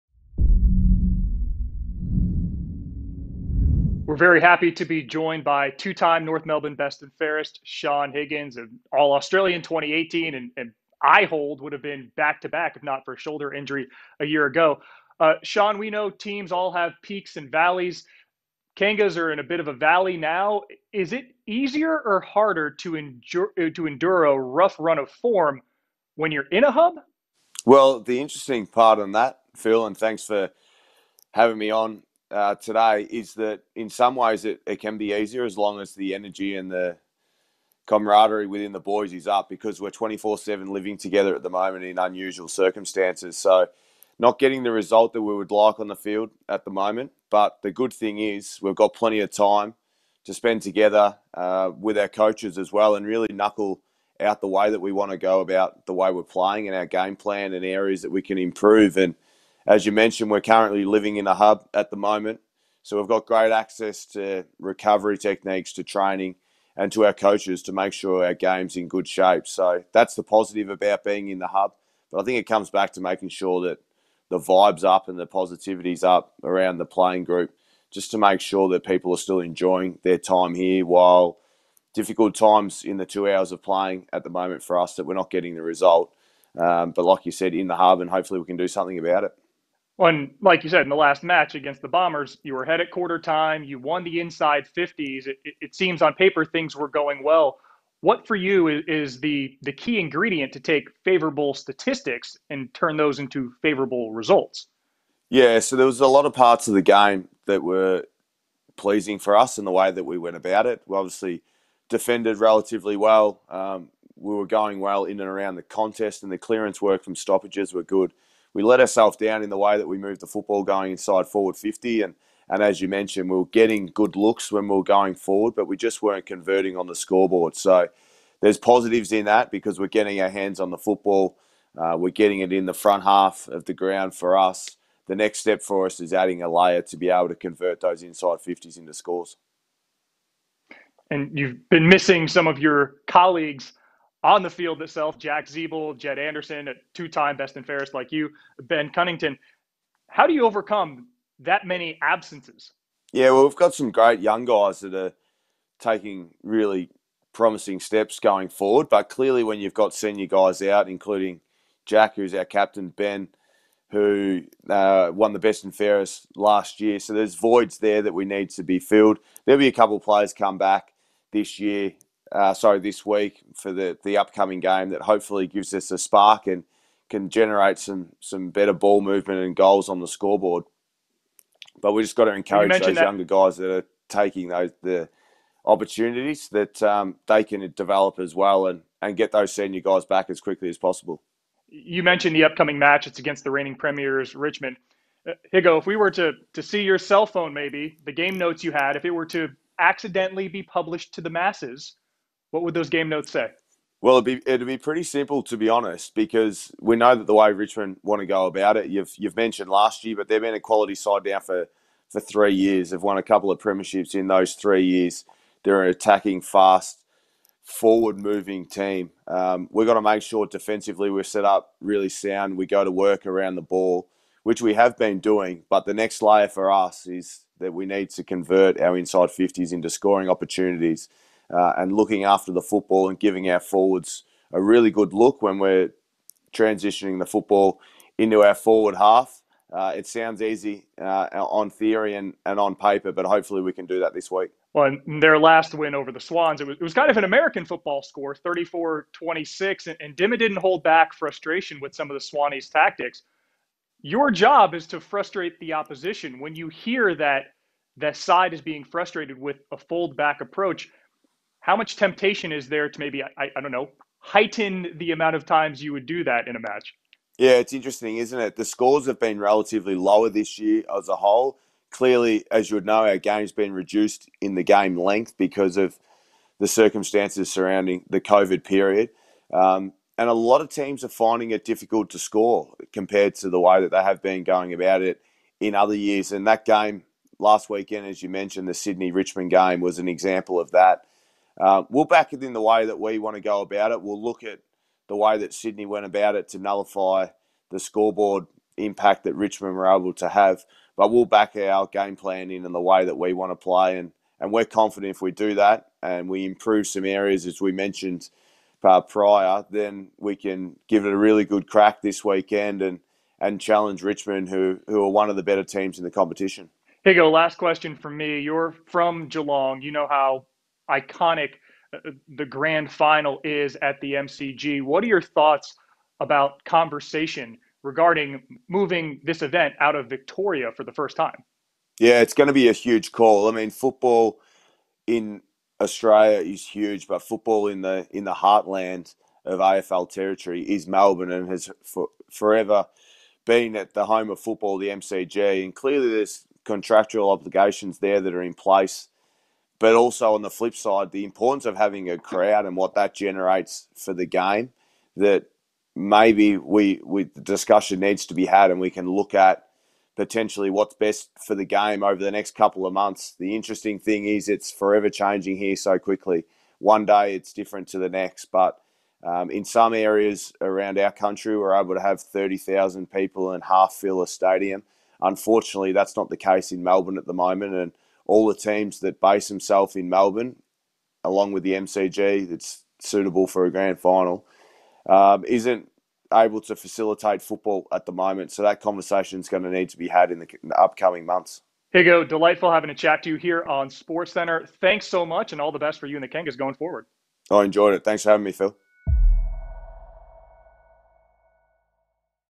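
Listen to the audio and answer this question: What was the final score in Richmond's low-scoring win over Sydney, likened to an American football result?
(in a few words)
34-26.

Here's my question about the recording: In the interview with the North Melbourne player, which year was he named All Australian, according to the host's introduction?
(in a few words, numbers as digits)
2018.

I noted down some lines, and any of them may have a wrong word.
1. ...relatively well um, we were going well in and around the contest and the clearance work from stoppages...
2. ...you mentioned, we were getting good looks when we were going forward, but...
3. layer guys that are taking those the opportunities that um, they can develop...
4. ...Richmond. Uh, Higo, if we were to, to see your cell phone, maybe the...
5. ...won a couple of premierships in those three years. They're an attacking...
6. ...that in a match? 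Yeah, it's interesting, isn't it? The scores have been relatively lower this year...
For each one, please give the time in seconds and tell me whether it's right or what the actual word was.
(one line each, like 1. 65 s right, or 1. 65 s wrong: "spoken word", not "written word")
1. 112 s right
2. 122 s right
3. 183 s wrong: "younger", not "layer"
4. 194 s right
5. 213 s right
6. 266 s right.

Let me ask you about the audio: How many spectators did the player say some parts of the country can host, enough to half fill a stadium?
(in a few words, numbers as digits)
30,000.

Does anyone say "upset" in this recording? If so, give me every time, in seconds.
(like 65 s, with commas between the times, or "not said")
not said.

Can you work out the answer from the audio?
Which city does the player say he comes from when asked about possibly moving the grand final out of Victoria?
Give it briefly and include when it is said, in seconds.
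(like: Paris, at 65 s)
Geelong, at 319 s.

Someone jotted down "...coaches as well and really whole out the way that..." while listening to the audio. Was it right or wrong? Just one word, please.
wrong.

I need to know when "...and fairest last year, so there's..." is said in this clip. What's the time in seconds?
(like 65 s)
165 s.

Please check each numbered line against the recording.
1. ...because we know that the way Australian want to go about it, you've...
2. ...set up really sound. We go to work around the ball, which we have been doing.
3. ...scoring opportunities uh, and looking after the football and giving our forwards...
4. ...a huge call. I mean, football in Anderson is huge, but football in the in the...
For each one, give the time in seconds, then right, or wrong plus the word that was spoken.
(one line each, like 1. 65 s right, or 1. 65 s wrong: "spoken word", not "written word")
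1. 206 s wrong: "Richmond", not "Australian"
2. 221 s right
3. 229 s right
4. 332 s wrong: "Australia", not "Anderson".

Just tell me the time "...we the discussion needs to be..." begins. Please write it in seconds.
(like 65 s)
357 s.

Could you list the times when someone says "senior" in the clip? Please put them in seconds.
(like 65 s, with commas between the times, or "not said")
159 s, 189 s.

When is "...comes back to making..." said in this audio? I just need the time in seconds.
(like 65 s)
72 s.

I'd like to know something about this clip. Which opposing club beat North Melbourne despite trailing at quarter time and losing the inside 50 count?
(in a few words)
Bombers.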